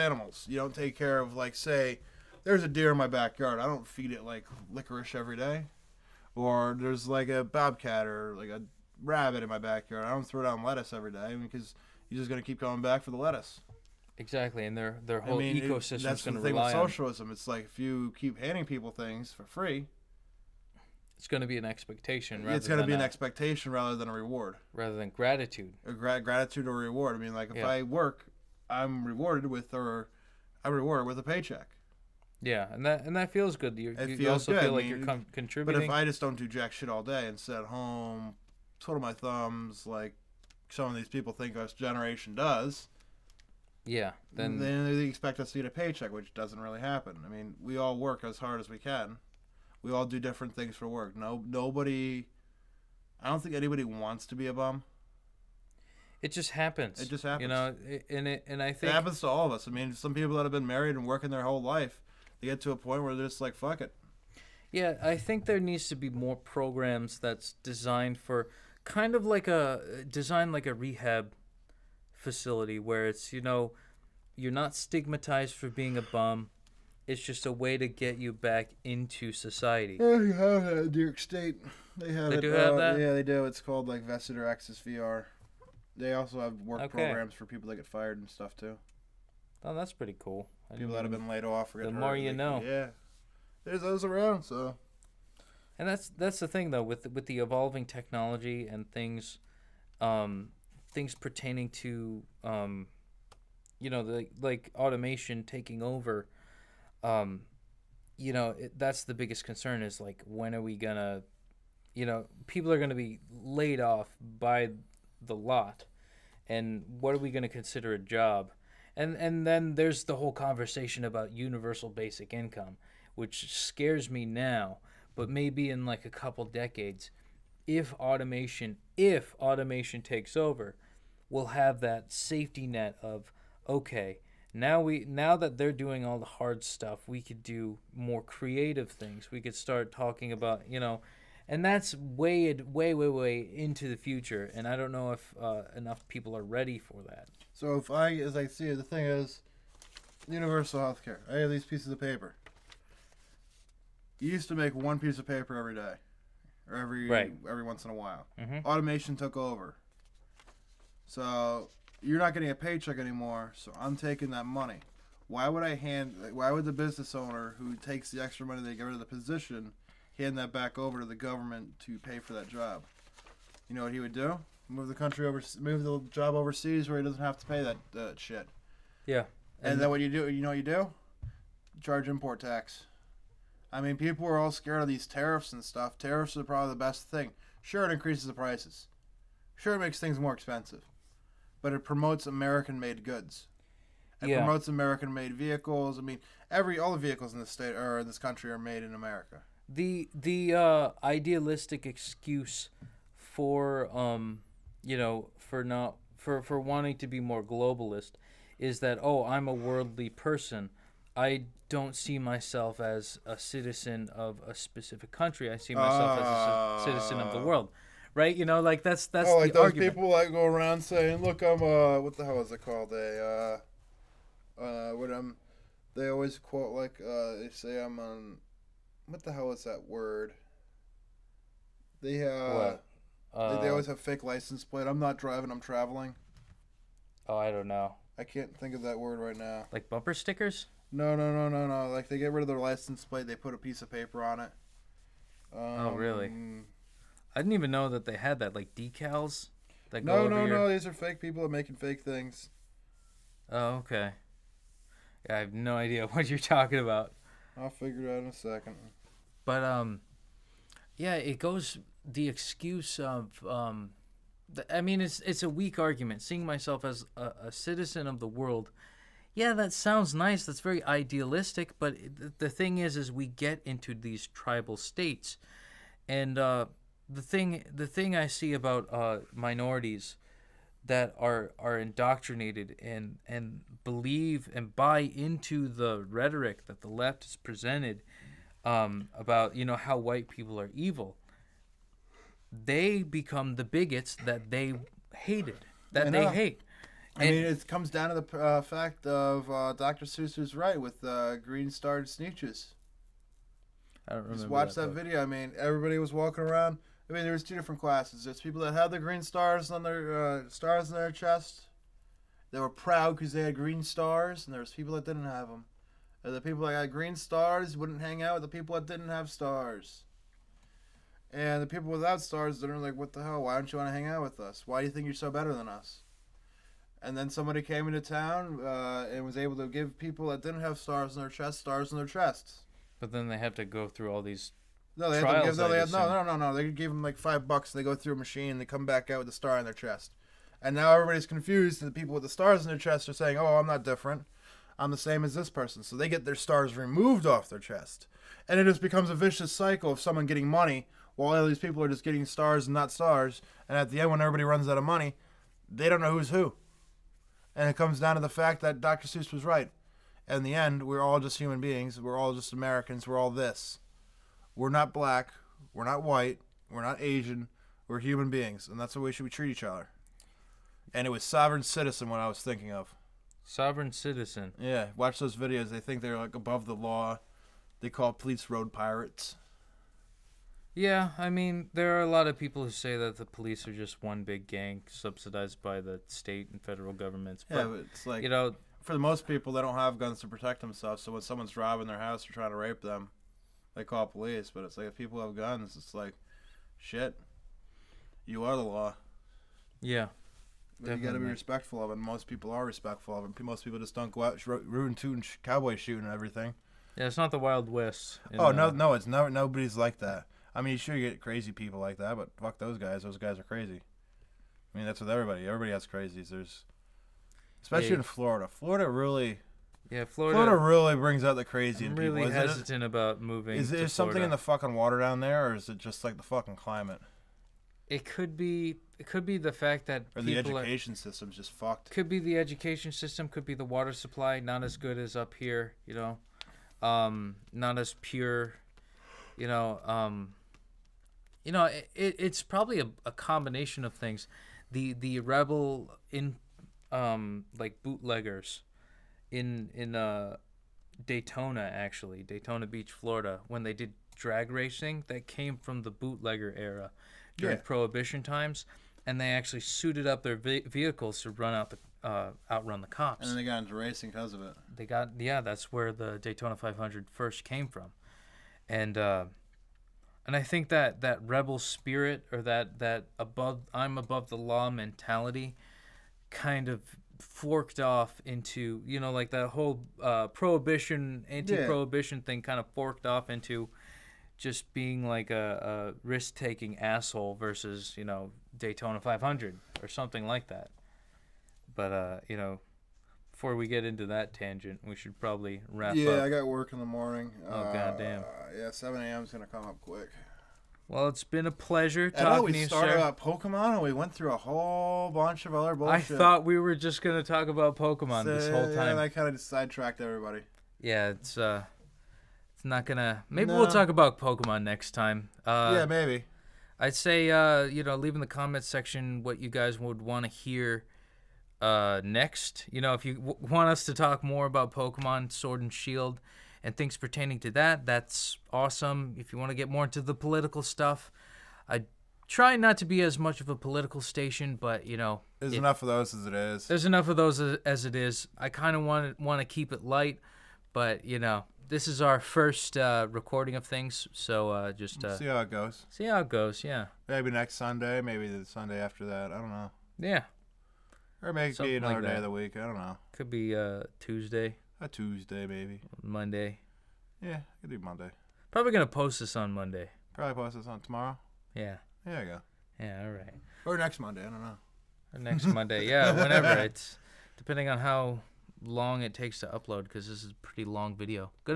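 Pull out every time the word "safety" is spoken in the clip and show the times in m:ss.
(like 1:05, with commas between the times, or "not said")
2:12.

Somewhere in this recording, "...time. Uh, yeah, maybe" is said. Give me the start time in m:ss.
8:34.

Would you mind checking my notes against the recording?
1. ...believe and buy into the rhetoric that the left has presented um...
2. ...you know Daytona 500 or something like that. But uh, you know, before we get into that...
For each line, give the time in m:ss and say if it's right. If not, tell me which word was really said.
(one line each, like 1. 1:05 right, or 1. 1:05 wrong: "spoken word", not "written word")
1. 4:43 right
2. 8:07 right.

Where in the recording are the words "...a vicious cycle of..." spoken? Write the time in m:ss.
5:49.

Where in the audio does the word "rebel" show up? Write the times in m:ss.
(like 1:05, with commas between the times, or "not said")
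7:25, 7:51.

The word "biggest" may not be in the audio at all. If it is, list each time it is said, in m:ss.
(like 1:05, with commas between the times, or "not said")
1:49.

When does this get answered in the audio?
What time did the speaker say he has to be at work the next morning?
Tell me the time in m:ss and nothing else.
8:18.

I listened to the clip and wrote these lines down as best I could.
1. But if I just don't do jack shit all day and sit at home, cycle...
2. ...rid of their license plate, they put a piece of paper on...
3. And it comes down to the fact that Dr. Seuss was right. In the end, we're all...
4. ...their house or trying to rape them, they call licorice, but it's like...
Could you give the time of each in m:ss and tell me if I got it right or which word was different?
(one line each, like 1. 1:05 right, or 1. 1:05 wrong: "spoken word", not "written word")
1. 0:35 wrong: "twiddle", not "cycle"
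2. 4:02 right
3. 5:57 right
4. 6:31 wrong: "police", not "licorice".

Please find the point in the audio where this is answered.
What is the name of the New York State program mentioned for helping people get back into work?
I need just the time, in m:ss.
1:24.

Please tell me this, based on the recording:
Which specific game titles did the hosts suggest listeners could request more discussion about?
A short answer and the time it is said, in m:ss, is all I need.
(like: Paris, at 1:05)
Pokemon Sword and Shield, at 8:44.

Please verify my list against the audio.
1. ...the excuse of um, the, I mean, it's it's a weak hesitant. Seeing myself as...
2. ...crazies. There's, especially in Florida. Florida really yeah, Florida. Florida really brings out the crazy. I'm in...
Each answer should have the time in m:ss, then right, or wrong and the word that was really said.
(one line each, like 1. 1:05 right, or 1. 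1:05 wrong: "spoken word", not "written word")
1. 4:22 wrong: "argument", not "hesitant"
2. 6:55 right.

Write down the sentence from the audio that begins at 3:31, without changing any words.
I don't see myself as a citizen of a specific country.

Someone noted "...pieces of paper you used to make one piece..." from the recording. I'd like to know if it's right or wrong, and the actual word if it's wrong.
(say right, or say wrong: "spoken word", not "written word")
right.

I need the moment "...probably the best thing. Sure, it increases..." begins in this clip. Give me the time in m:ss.
3:06.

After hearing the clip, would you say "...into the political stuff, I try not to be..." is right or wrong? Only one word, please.
right.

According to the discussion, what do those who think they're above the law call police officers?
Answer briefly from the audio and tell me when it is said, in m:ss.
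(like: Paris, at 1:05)
road pirates, at 6:18.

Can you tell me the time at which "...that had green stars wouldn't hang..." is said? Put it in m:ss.
5:16.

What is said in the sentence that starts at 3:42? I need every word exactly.
A uh, uh, what I'm." They always quote like uh, they say I'm on, what the hell is that word?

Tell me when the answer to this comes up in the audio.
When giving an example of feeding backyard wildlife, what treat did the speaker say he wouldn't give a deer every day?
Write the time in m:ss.
0:04.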